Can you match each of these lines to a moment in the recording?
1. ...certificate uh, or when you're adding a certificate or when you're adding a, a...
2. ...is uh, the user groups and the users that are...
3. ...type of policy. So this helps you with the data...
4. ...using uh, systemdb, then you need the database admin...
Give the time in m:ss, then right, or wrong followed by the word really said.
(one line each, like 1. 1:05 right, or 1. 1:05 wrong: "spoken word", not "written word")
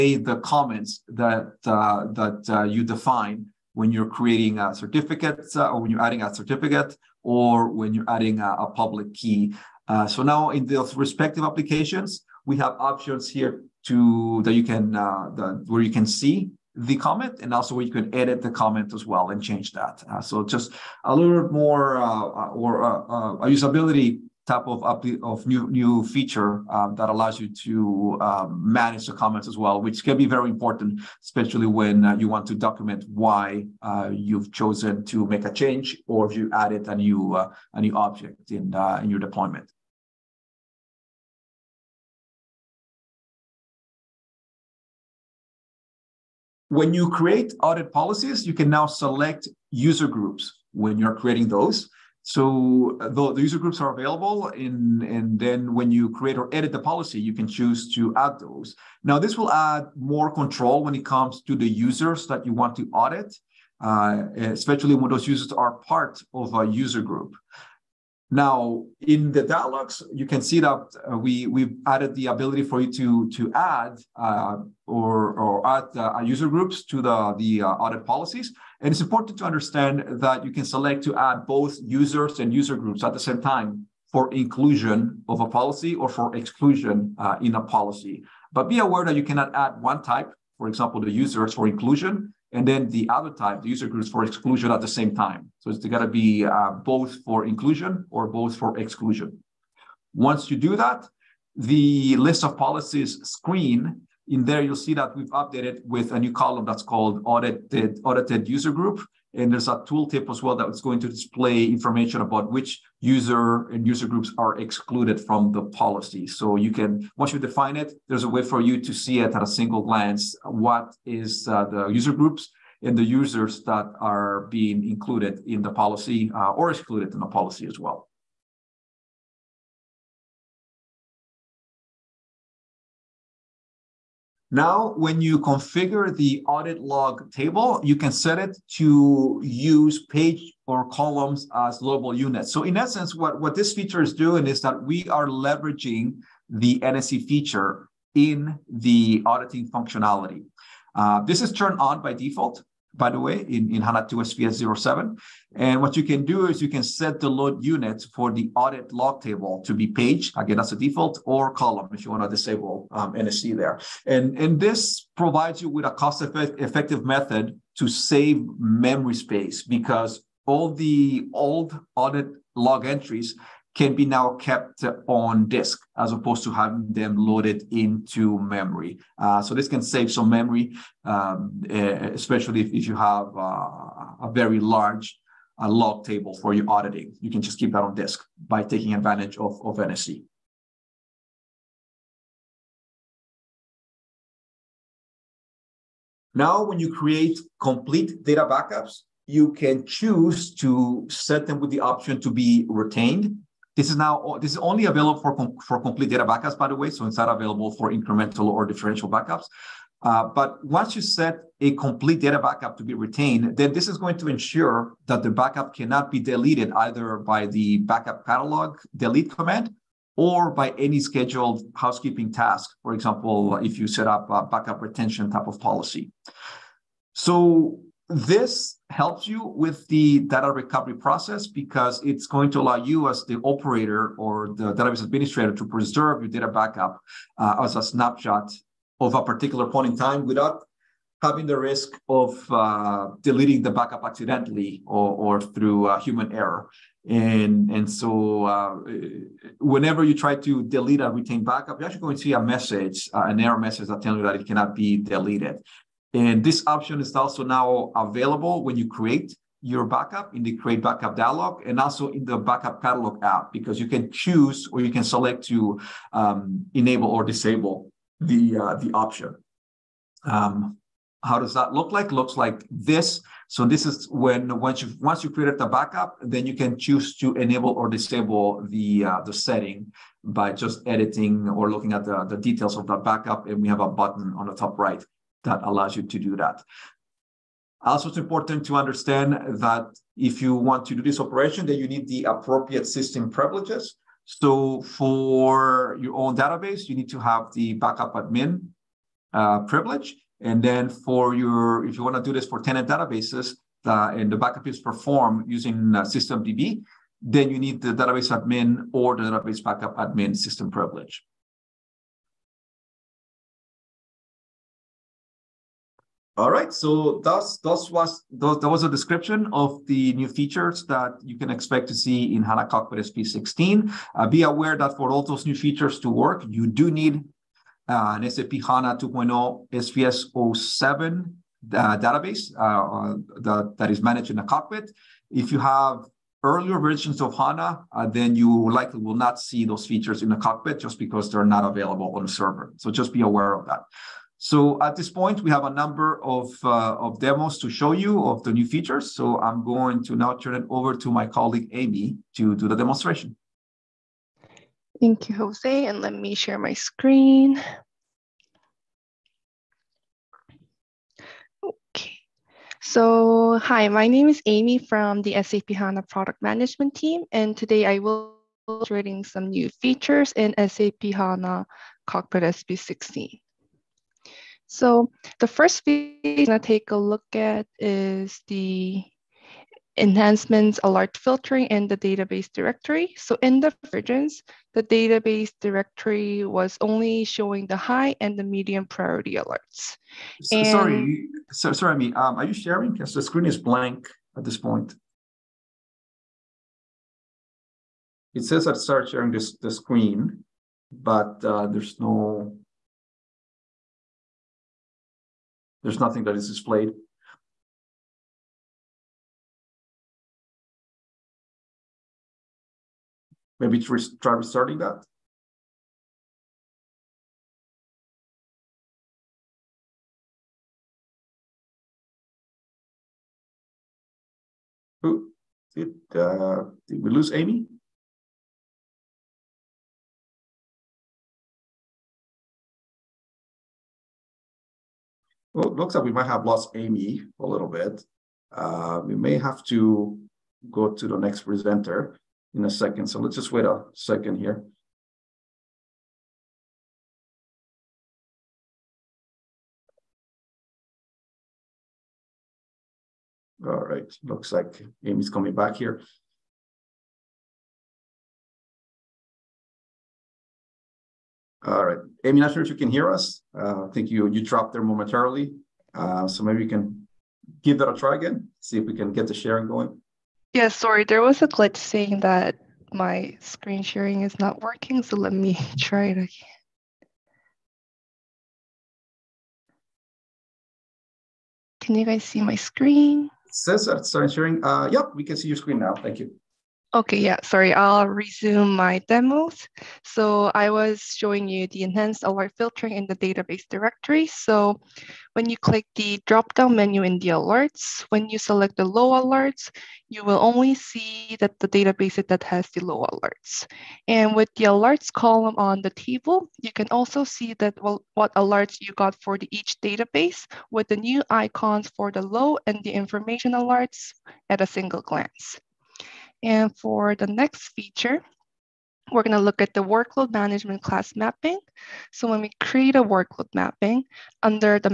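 1. 0:04 right
2. 2:01 right
3. 3:45 right
4. 5:05 right.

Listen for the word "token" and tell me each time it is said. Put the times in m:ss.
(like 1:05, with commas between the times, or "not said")
not said.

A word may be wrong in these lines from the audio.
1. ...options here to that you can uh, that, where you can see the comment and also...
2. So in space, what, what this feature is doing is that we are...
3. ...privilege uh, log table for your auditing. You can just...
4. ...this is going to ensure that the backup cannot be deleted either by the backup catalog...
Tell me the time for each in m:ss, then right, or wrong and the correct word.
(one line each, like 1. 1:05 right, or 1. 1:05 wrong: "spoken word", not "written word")
1. 0:12 right
2. 2:22 wrong: "essence", not "space"
3. 3:04 wrong: "large", not "privilege"
4. 3:33 right.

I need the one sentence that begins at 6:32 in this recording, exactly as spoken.
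Because the screen is blank at this point.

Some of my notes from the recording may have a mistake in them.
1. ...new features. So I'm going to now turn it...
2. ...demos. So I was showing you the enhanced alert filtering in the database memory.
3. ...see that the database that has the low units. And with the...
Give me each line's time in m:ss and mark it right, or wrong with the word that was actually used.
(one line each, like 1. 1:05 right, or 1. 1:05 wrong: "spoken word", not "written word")
1. 5:48 right
2. 8:09 wrong: "directory", not "memory"
3. 8:20 wrong: "alerts", not "units".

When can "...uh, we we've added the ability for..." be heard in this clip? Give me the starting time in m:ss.
1:11.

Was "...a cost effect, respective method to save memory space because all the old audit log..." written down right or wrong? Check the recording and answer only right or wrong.
wrong.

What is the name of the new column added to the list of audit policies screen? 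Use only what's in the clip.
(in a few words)
Audited user group.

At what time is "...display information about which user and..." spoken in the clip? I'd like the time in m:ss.
1:51.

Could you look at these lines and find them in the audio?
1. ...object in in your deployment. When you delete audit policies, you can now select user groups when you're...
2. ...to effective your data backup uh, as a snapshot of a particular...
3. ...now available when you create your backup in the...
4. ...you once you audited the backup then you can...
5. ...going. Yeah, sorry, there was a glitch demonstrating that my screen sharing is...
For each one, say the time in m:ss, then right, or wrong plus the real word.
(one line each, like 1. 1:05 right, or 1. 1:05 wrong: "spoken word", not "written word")
1. 0:37 wrong: "create", not "delete"
2. 3:55 wrong: "preserve", not "effective"
3. 4:17 right
4. 4:34 wrong: "created", not "audited"
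5. 7:49 wrong: "saying", not "demonstrating".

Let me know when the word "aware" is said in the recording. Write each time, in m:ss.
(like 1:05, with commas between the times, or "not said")
1:28, 5:24, 5:43.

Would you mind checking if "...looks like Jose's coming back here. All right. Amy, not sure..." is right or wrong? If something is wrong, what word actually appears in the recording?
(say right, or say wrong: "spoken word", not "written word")
wrong: "Amy", not "Jose".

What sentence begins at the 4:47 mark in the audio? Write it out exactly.
Also, it's important to understand that if you want to do this operation, that you need the appropriate system privileges.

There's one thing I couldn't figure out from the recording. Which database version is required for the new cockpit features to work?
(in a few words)
SAP HANA 2.0 SPS 07.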